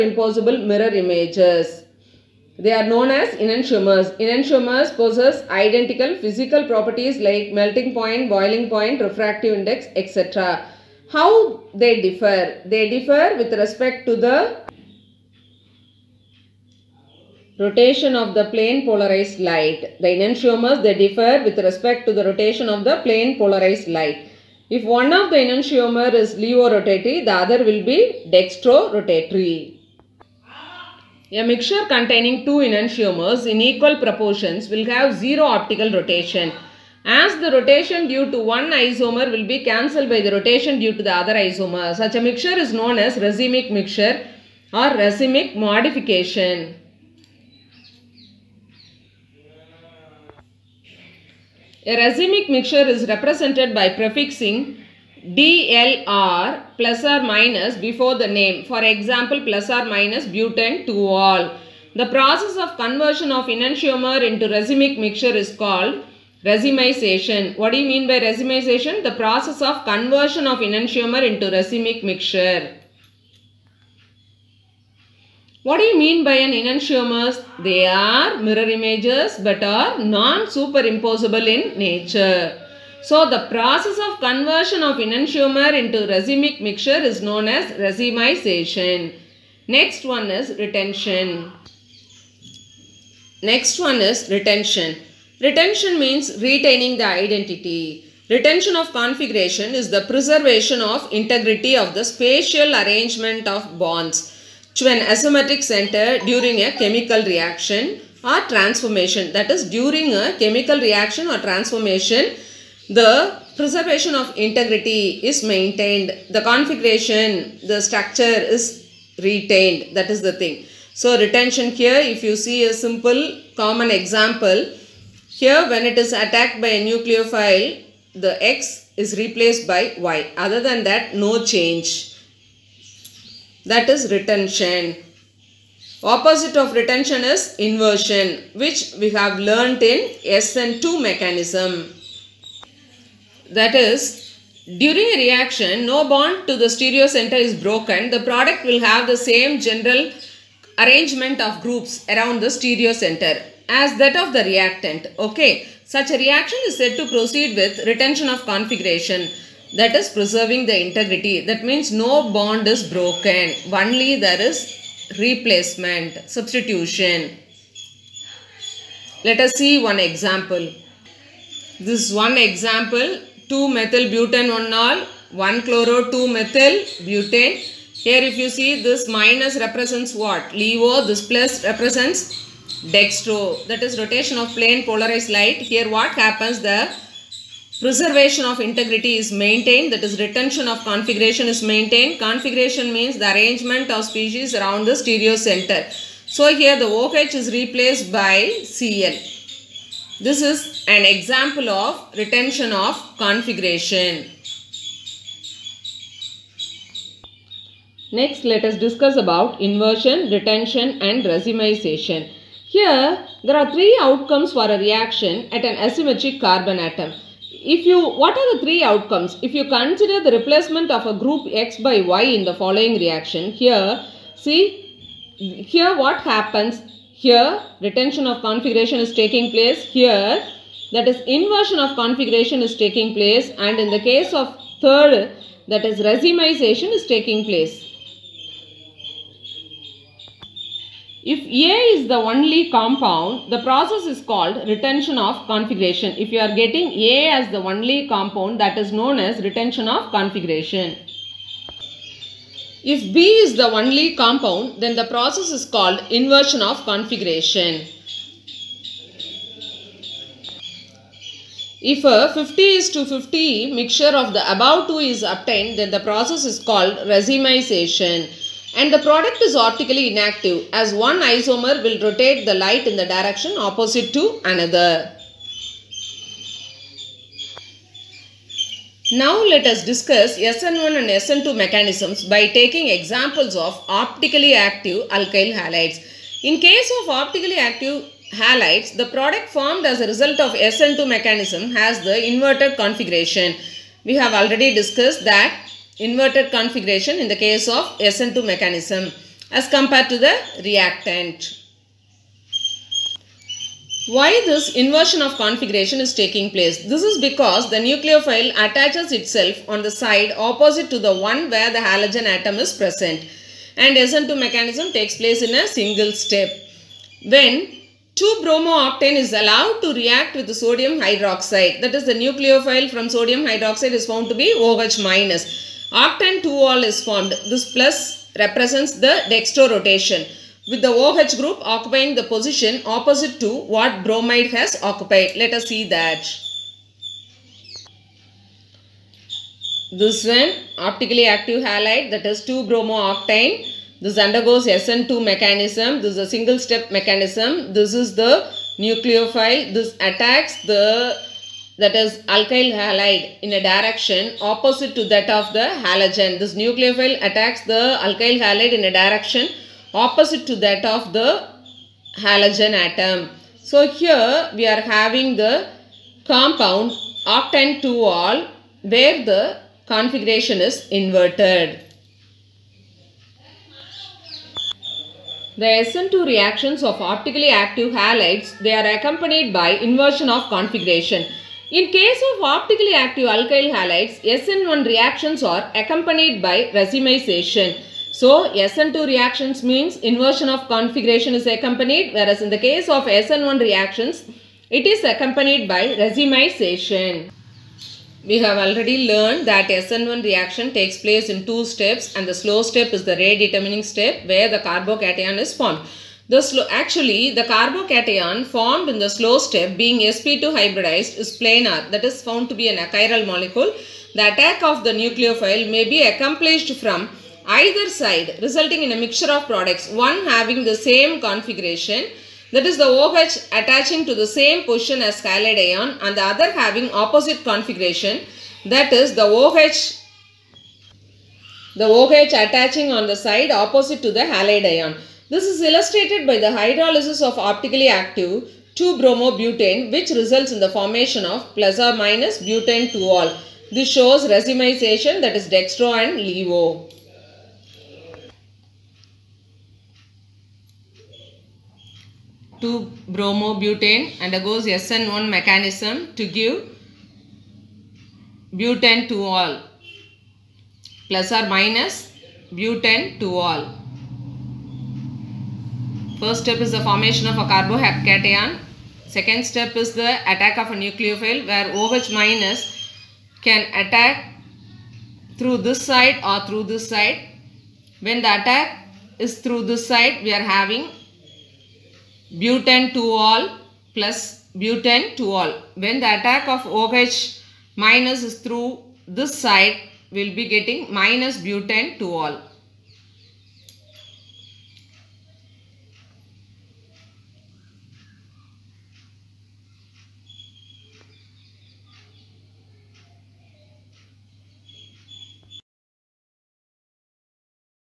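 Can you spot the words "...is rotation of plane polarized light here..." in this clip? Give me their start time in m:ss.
3:03.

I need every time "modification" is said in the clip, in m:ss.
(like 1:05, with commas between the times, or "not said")
0:45.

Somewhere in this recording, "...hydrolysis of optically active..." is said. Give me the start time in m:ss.
7:16.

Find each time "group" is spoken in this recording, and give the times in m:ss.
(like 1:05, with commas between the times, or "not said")
2:31, 3:41, 5:31.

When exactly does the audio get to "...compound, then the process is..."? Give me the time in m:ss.
4:14.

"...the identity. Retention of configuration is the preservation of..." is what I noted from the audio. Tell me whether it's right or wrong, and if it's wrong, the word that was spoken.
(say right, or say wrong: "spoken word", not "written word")
right.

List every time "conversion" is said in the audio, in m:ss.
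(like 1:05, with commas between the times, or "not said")
1:02, 1:09, 1:24.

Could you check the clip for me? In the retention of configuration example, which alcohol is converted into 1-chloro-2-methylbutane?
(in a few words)
2-methylbutan-1-ol.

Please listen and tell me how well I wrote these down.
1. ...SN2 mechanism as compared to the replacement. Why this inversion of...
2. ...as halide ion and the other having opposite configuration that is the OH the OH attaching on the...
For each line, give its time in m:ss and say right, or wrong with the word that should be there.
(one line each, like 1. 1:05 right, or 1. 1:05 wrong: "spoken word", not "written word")
1. 4:58 wrong: "reactant", not "replacement"
2. 7:05 right.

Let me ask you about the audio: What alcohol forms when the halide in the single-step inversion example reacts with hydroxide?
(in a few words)
octan-2-ol.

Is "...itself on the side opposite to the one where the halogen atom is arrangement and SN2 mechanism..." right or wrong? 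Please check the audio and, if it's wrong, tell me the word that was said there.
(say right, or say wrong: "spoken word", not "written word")
wrong: "present", not "arrangement".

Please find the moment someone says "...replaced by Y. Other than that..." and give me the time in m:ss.
2:09.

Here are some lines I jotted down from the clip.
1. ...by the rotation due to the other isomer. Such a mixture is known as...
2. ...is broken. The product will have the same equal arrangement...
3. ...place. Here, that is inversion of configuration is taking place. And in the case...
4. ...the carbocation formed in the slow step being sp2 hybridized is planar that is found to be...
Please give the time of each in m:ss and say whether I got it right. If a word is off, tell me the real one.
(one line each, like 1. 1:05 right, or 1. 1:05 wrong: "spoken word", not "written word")
1. 0:40 right
2. 2:27 wrong: "general", not "equal"
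3. 3:49 right
4. 6:47 right.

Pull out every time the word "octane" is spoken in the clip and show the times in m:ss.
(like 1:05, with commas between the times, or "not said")
5:18, 5:25, 5:42, 6:07.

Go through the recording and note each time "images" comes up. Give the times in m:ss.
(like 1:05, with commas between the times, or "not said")
0:01, 1:18.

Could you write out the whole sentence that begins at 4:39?
Now let us discuss SN1 and SN2 mechanisms by taking examples of optically active alkyl halides.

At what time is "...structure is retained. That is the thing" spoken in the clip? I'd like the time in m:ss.
1:57.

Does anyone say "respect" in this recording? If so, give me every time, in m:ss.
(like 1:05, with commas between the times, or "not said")
0:13, 0:21.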